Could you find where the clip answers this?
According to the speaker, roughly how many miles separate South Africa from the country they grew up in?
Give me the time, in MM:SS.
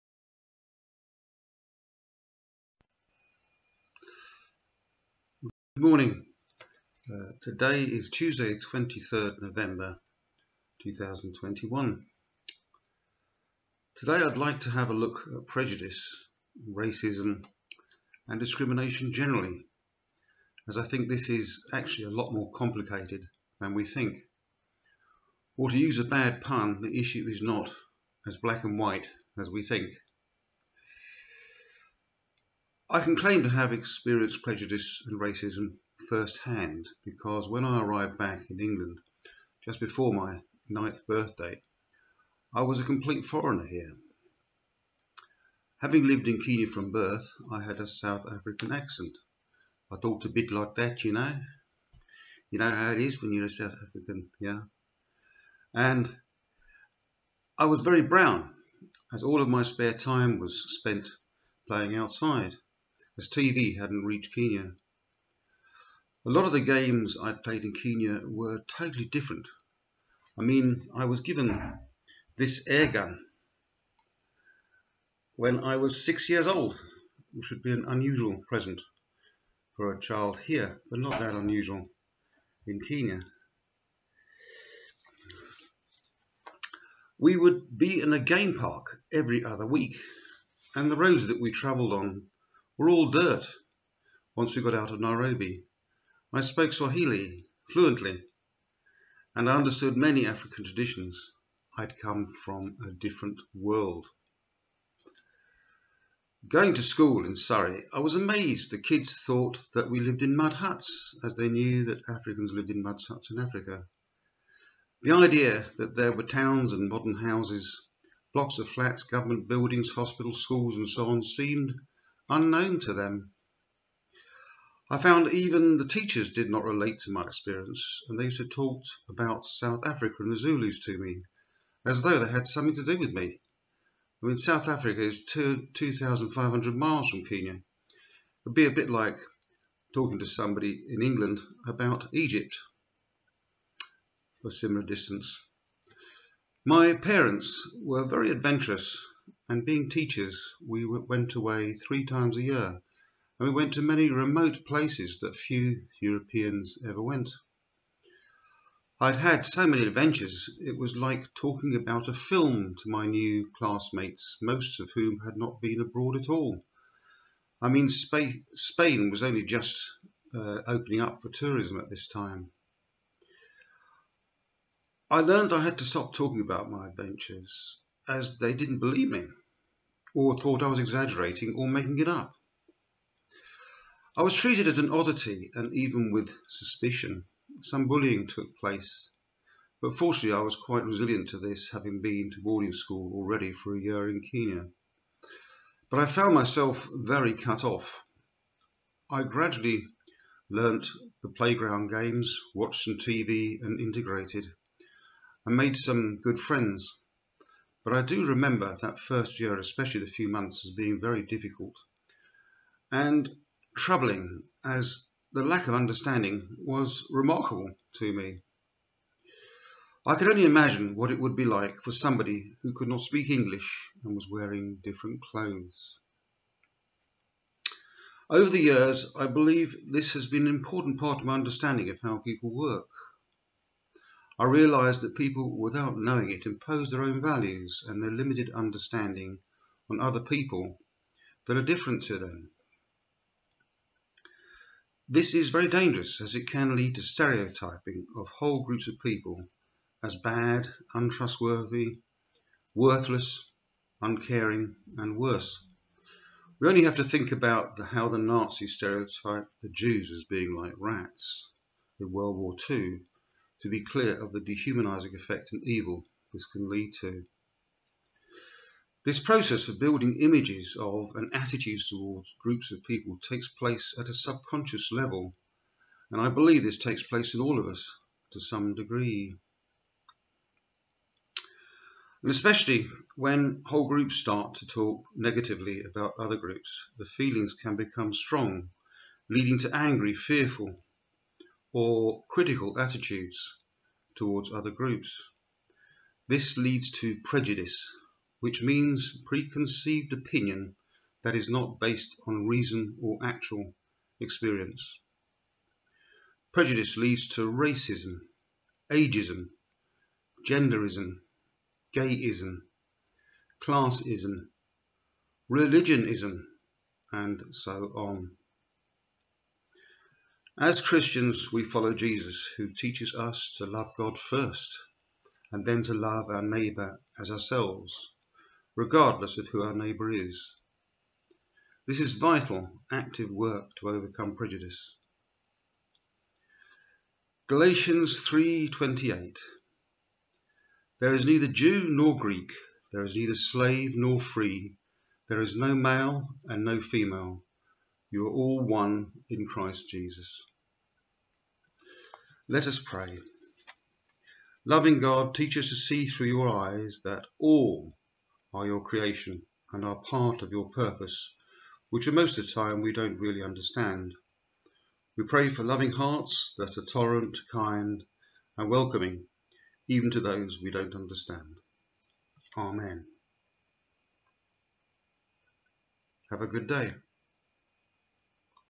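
02:15.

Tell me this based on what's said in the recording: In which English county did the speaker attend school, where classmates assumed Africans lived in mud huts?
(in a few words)
Surrey.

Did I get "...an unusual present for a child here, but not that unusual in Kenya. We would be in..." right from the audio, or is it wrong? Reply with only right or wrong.
right.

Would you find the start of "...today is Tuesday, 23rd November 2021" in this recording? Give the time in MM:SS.
00:07.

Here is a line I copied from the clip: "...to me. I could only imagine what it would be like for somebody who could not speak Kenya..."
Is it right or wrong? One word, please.
wrong.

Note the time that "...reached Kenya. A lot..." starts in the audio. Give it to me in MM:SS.
01:04.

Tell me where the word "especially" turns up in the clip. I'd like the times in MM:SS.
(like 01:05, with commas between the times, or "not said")
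03:29, 04:42.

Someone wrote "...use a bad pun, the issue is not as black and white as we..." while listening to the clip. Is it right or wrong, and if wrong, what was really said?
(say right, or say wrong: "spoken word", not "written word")
right.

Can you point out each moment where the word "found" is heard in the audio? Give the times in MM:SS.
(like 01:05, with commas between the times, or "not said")
02:04, 03:16.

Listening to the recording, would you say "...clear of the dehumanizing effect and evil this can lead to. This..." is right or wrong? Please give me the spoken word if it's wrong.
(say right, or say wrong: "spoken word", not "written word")
right.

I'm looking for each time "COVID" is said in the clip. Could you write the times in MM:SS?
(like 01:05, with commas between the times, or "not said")
not said.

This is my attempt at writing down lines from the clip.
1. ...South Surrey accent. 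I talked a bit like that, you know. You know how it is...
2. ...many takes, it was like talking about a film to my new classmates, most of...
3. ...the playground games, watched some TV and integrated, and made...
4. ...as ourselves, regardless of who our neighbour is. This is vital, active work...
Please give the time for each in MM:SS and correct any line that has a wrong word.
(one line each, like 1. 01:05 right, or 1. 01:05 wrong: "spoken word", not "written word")
1. 00:47 wrong: "African", not "Surrey"
2. 02:39 wrong: "adventures", not "takes"
3. 03:21 right
4. 05:27 right.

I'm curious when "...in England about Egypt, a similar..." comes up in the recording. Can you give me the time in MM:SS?
02:20.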